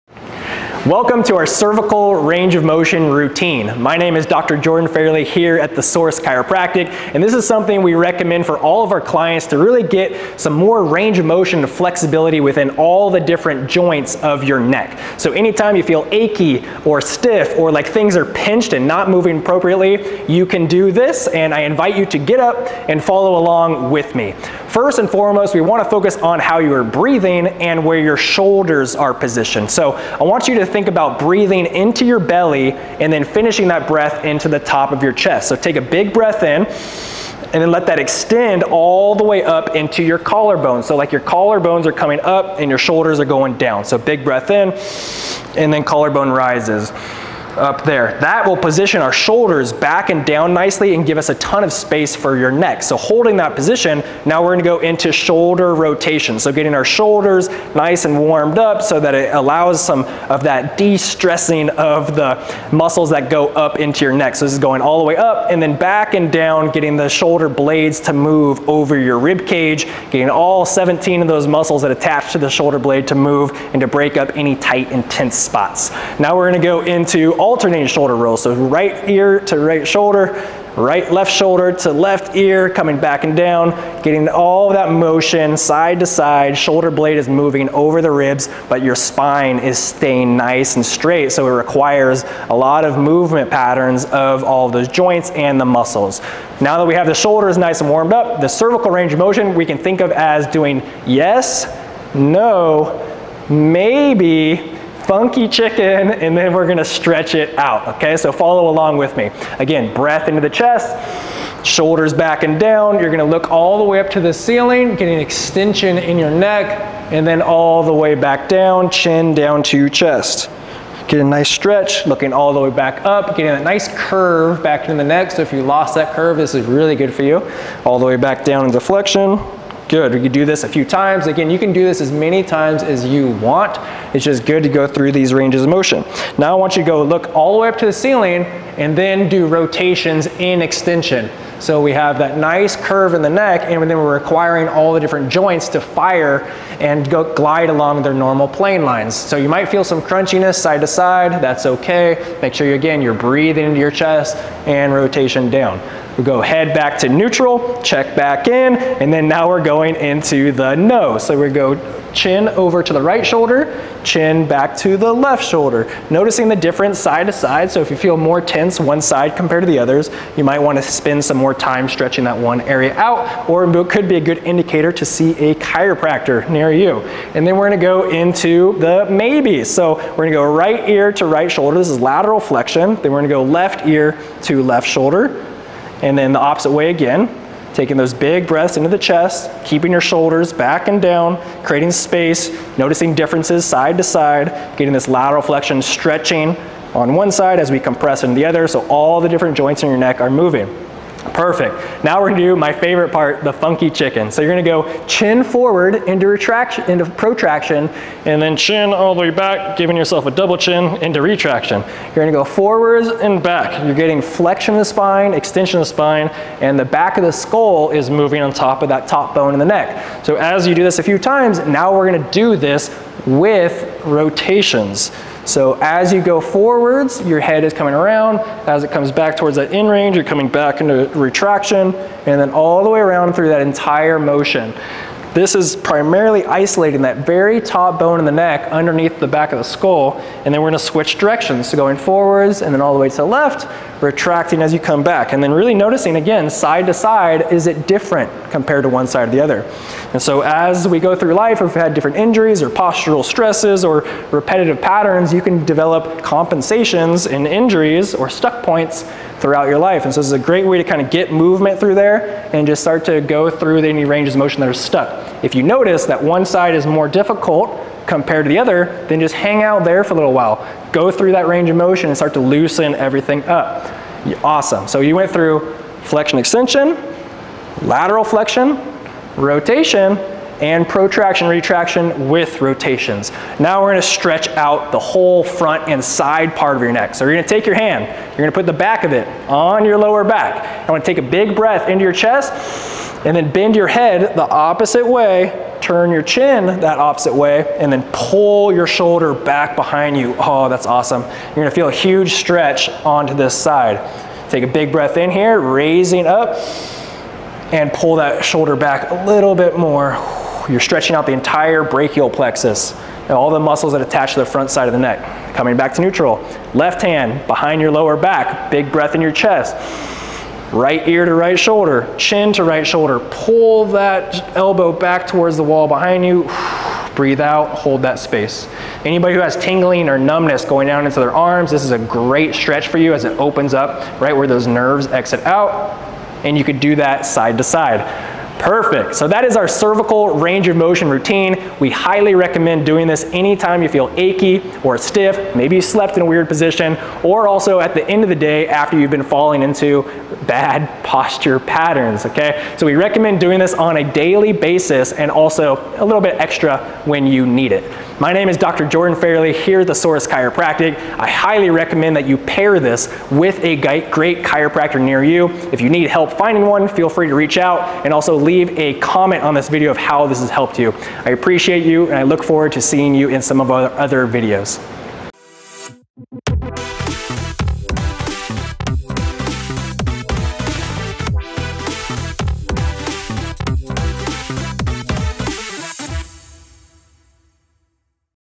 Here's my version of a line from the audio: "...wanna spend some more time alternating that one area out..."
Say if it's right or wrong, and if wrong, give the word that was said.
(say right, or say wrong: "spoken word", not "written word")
wrong: "stretching", not "alternating".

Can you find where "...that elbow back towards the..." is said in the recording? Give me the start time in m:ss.
5:23.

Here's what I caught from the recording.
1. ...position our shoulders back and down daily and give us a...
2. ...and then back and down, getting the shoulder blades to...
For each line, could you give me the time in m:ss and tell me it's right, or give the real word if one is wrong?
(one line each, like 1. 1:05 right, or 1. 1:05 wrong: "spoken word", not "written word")
1. 0:48 wrong: "nicely", not "daily"
2. 1:05 right.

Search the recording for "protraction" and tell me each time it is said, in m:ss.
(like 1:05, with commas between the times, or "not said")
3:27, 4:40.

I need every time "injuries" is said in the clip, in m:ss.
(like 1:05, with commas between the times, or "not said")
4:12, 4:17.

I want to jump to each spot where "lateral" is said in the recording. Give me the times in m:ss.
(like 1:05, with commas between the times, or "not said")
3:02, 3:15, 4:37.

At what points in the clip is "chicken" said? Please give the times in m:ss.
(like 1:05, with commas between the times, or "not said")
1:45, 3:23.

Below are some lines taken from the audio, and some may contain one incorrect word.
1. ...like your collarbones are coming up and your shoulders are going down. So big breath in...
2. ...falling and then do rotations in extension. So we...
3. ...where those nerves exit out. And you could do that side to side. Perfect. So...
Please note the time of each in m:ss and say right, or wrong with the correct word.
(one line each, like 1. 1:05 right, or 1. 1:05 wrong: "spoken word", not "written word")
1. 0:40 right
2. 2:17 wrong: "ceiling", not "falling"
3. 5:34 right.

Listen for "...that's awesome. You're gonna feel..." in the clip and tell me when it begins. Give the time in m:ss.
5:00.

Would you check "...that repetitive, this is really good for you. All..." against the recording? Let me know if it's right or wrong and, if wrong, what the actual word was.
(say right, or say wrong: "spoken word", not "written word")
wrong: "curve", not "repetitive".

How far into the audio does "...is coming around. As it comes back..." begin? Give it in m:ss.
3:47.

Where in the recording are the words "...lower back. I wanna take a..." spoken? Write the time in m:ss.
4:49.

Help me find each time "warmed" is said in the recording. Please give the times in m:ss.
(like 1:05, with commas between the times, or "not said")
0:58, 1:37.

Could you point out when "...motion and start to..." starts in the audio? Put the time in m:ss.
4:31.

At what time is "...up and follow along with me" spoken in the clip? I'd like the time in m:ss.
0:22.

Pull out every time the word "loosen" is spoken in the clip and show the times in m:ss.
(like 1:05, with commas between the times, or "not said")
4:32.